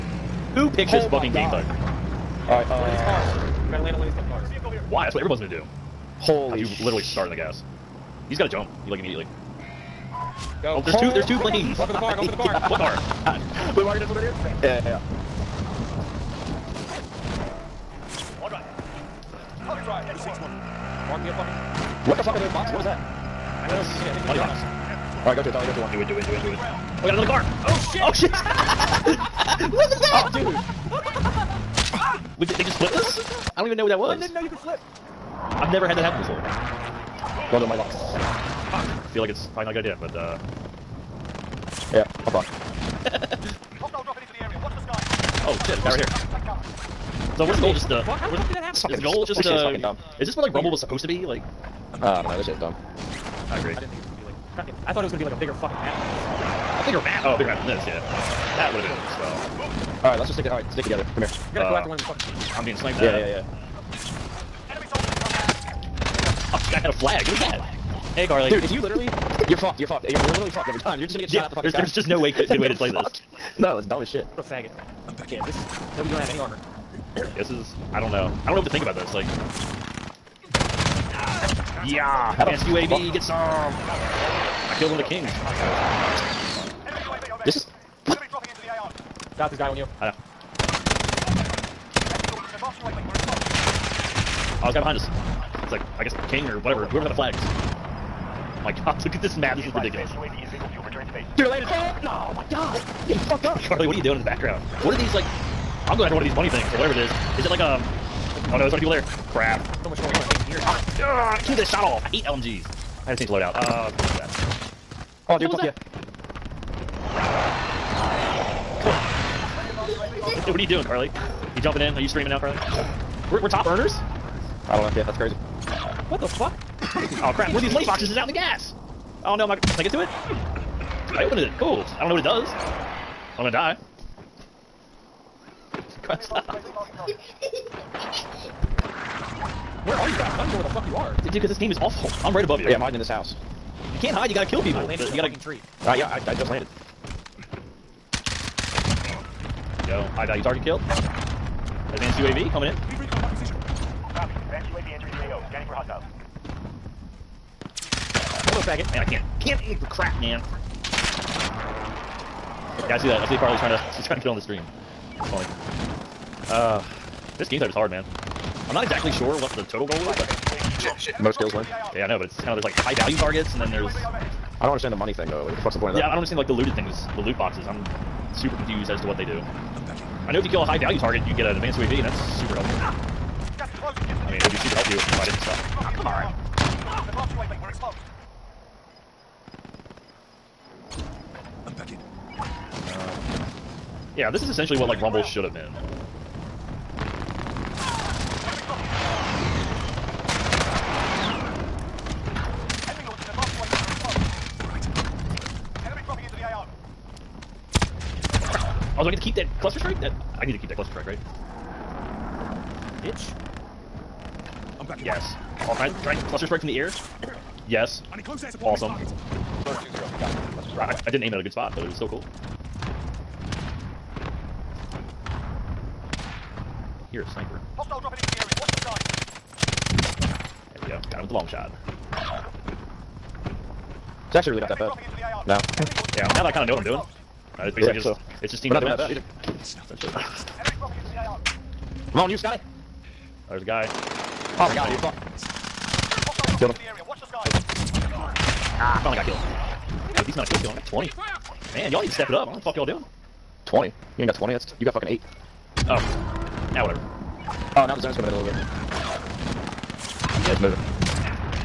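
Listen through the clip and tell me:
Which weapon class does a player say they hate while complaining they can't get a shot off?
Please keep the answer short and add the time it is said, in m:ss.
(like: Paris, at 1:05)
LMGs, at 1:52.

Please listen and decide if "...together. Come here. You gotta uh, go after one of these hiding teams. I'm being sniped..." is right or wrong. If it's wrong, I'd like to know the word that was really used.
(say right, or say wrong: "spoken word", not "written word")
wrong: "fucking", not "hiding".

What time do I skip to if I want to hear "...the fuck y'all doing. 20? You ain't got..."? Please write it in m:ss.
4:12.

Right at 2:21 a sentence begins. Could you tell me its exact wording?
Dude, because this game is awful.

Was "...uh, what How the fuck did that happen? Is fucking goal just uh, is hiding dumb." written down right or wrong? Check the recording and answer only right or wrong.
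wrong.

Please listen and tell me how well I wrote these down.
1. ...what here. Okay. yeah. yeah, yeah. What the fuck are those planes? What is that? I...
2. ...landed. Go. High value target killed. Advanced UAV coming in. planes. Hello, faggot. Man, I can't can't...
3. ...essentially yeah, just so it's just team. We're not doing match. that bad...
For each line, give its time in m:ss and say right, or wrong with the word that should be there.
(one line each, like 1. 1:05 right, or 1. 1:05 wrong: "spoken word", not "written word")
1. 0:14 wrong: "boxes", not "planes"
2. 2:26 wrong: "hostiles", not "planes"
3. 3:57 wrong: "basically", not "essentially".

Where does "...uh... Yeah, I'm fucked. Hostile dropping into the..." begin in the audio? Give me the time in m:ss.
0:40.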